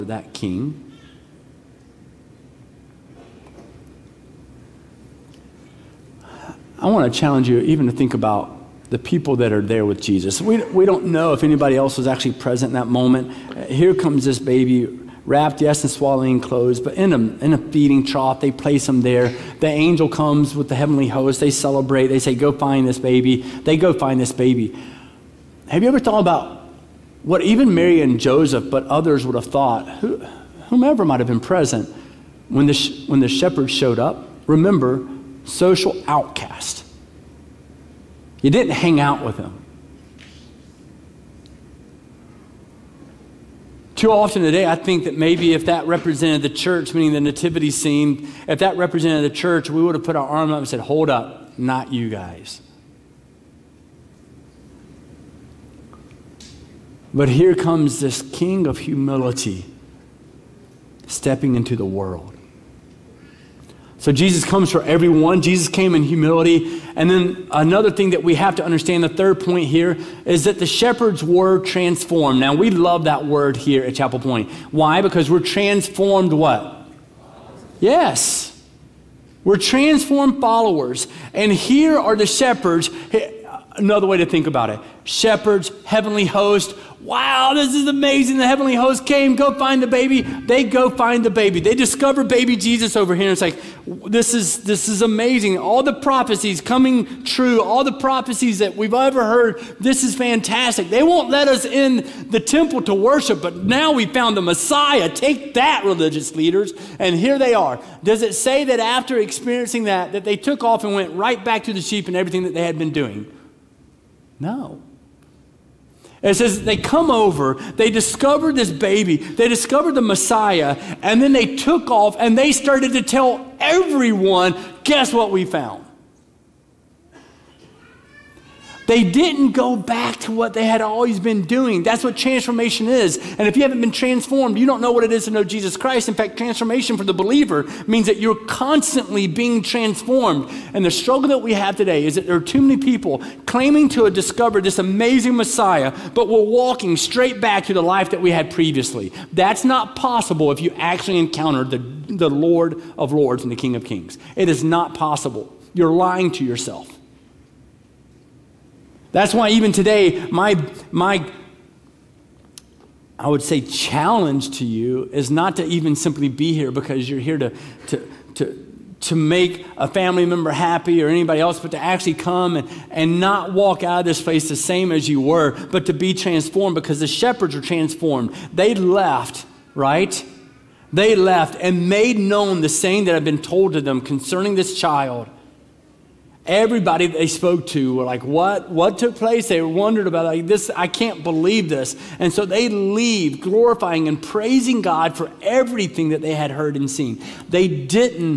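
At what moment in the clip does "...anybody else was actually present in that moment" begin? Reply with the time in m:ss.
0:11.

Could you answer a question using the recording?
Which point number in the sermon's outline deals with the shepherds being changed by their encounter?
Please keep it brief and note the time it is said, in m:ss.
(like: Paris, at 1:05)
3, at 1:09.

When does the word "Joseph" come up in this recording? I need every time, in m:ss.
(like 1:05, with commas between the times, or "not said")
0:28.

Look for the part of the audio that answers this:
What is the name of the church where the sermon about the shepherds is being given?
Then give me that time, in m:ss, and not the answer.
1:13.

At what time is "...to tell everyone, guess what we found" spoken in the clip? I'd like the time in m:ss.
2:02.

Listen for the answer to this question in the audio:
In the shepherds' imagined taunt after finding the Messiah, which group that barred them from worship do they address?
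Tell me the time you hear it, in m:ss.
1:45.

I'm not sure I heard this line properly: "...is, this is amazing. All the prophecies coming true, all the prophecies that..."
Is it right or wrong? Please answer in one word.
right.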